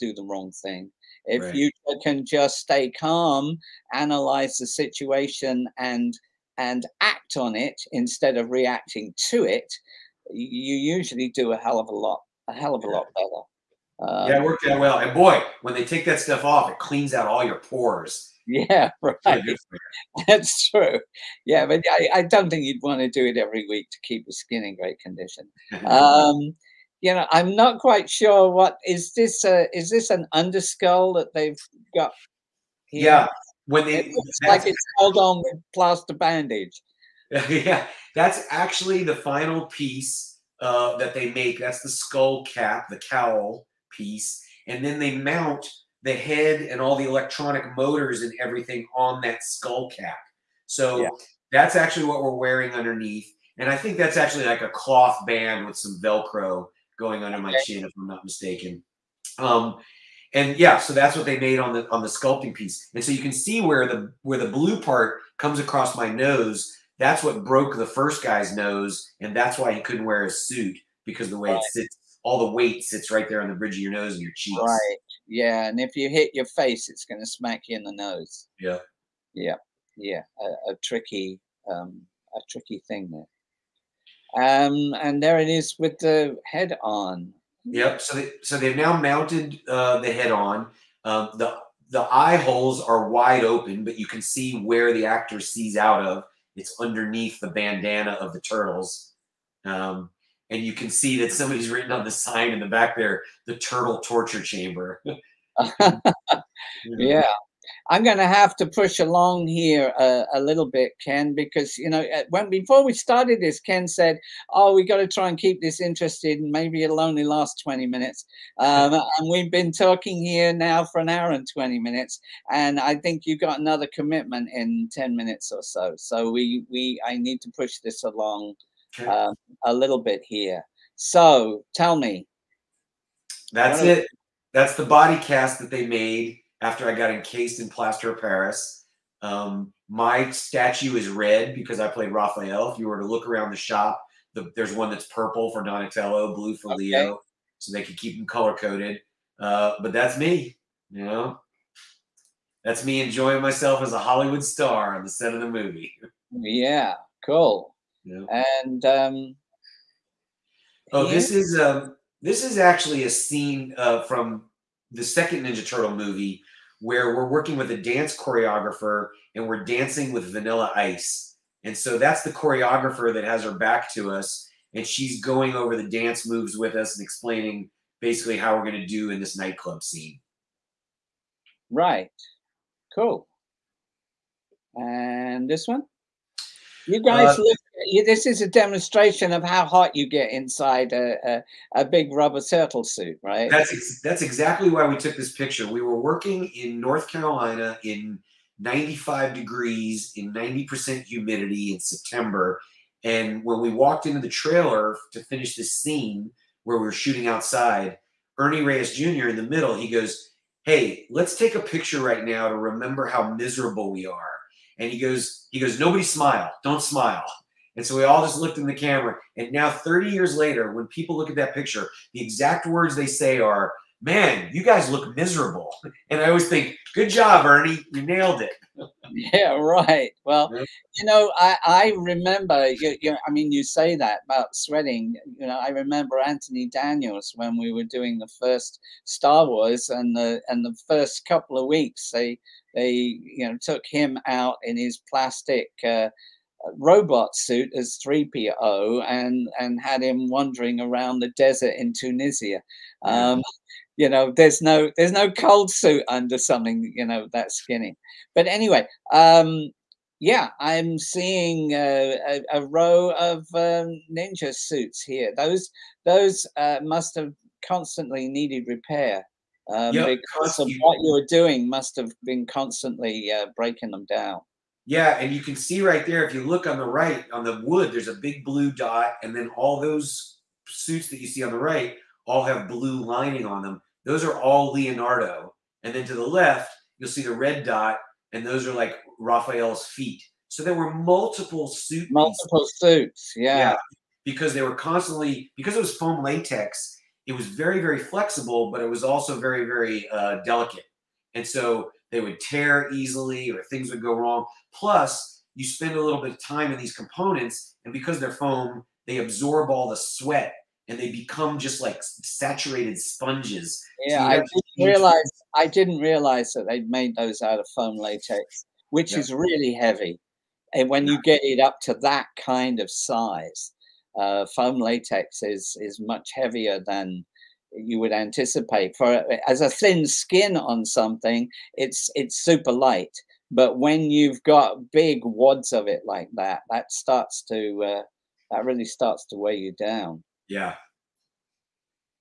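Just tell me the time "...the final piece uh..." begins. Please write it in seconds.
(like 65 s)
39 s.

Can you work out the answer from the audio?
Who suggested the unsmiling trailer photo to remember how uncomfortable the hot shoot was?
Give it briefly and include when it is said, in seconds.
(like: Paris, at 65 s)
Ernie Reyes Jr., at 208 s.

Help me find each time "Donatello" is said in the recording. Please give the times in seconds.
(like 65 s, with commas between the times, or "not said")
145 s.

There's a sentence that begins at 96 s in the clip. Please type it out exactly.
It's underneath the bandana of the turtles.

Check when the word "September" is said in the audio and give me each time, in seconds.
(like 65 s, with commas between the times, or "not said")
201 s.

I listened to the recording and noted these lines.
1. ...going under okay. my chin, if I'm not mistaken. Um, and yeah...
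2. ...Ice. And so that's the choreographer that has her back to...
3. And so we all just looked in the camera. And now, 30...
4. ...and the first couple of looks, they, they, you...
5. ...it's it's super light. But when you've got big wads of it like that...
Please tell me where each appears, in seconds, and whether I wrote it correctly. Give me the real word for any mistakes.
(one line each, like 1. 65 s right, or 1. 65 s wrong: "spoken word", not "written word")
1. 56 s right
2. 170 s right
3. 217 s right
4. 240 s wrong: "weeks", not "looks"
5. 331 s right.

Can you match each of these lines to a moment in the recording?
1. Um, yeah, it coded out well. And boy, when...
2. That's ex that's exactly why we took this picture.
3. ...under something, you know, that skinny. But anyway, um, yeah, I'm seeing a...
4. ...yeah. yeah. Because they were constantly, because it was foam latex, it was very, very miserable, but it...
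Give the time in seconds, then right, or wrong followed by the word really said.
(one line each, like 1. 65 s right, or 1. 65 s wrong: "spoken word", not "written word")
1. 14 s wrong: "worked", not "coded"
2. 193 s right
3. 256 s right
4. 293 s wrong: "flexible", not "miserable".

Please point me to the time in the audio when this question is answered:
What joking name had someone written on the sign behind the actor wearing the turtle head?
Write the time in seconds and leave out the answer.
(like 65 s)
103 s.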